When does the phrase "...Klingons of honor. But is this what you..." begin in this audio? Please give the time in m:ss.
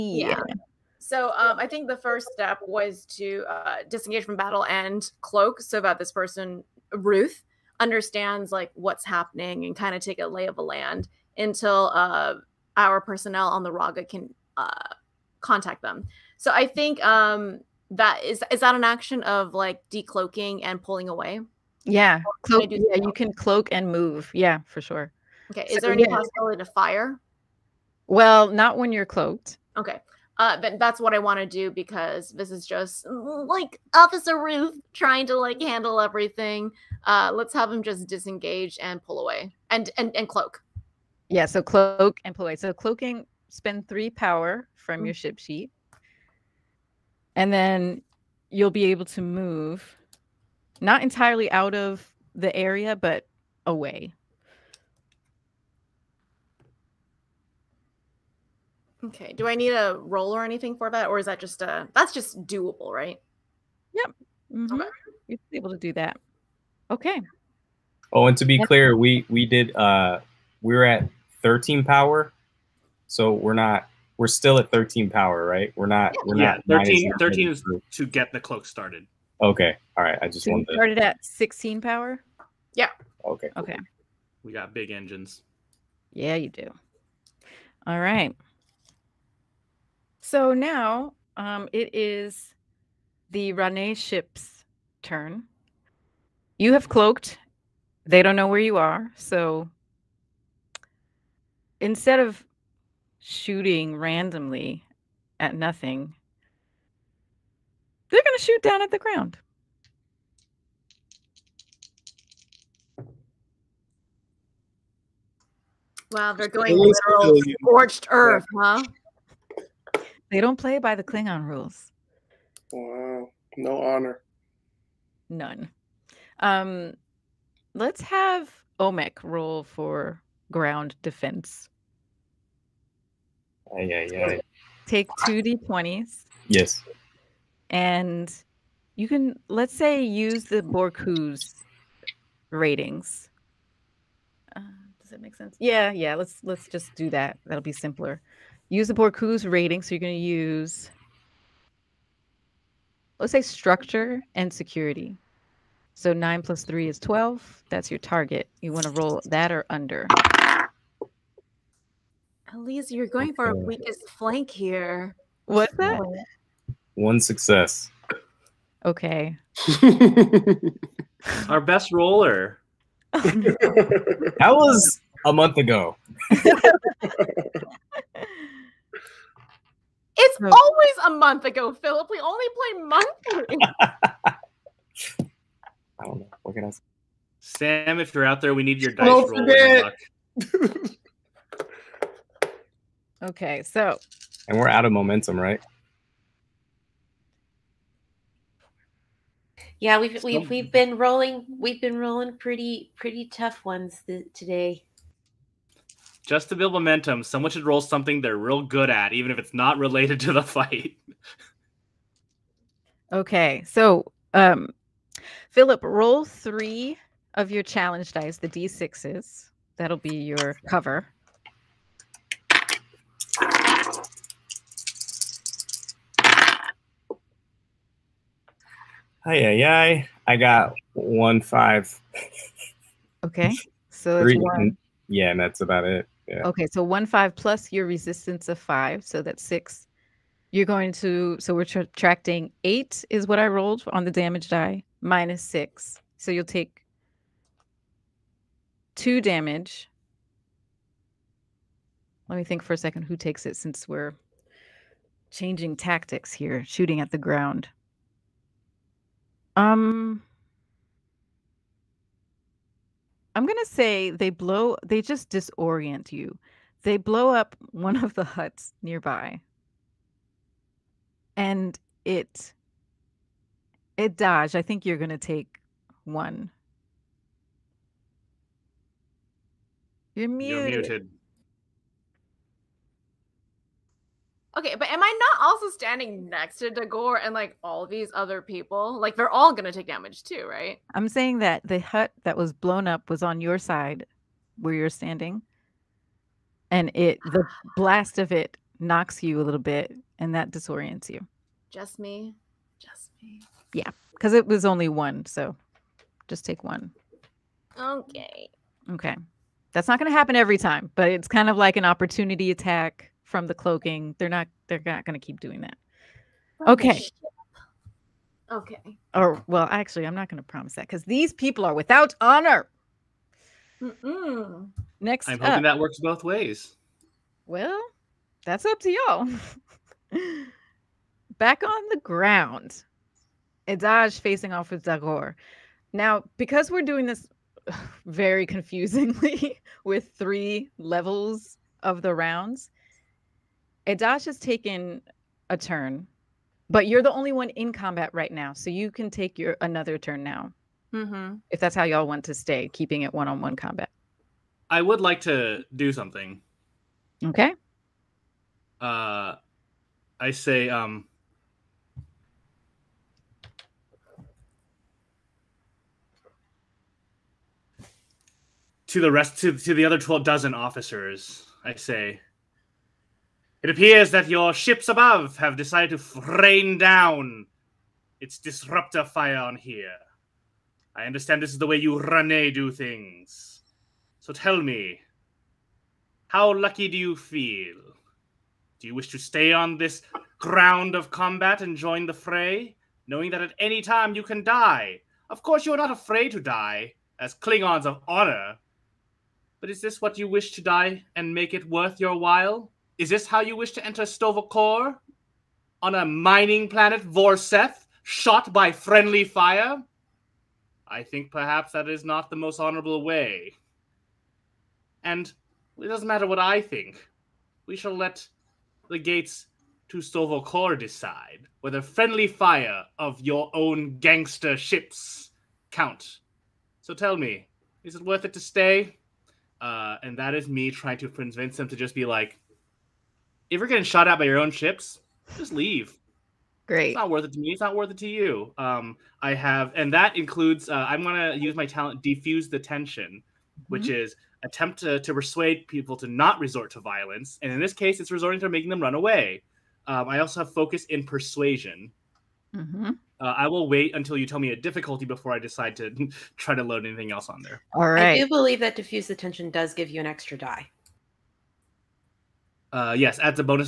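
6:37.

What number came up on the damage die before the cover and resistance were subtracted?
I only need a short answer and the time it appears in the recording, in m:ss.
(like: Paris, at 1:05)
8, at 4:02.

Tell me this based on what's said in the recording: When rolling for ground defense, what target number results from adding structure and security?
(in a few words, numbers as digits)
12.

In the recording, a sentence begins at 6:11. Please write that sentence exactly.
I say, it appears that your ships above have decided to rain down its disruptor fire on here.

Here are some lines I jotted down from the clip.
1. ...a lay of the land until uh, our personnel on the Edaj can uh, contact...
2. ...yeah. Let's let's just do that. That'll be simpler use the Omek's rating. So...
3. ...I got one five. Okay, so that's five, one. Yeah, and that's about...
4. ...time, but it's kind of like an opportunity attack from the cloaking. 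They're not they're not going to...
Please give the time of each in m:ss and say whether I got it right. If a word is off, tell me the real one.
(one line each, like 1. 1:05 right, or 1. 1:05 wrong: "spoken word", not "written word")
1. 0:10 wrong: "Raga", not "Edaj"
2. 2:25 wrong: "Borku", not "Omek"
3. 3:50 wrong: "three", not "five"
4. 5:10 right.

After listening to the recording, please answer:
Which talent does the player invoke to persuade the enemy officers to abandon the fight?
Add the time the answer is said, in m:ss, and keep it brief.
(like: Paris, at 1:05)
Defuse the Tension, at 7:22.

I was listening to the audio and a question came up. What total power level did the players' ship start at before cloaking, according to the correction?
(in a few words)
16.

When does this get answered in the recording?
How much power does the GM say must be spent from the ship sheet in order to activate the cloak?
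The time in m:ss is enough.
0:43.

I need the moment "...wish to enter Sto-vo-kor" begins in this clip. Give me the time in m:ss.
6:43.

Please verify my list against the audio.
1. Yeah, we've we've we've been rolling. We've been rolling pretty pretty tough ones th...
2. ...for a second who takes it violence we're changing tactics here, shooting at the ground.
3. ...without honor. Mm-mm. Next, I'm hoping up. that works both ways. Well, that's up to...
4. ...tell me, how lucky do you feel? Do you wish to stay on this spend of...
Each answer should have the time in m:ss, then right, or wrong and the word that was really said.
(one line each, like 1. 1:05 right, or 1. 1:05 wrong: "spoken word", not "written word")
1. 3:19 right
2. 4:12 wrong: "since", not "violence"
3. 5:21 right
4. 6:24 wrong: "ground", not "spend".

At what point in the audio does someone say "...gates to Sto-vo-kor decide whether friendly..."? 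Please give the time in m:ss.
6:58.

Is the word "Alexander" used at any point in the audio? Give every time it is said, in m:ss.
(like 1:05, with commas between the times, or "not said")
not said.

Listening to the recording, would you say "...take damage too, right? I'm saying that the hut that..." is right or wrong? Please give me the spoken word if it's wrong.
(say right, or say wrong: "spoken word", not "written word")
right.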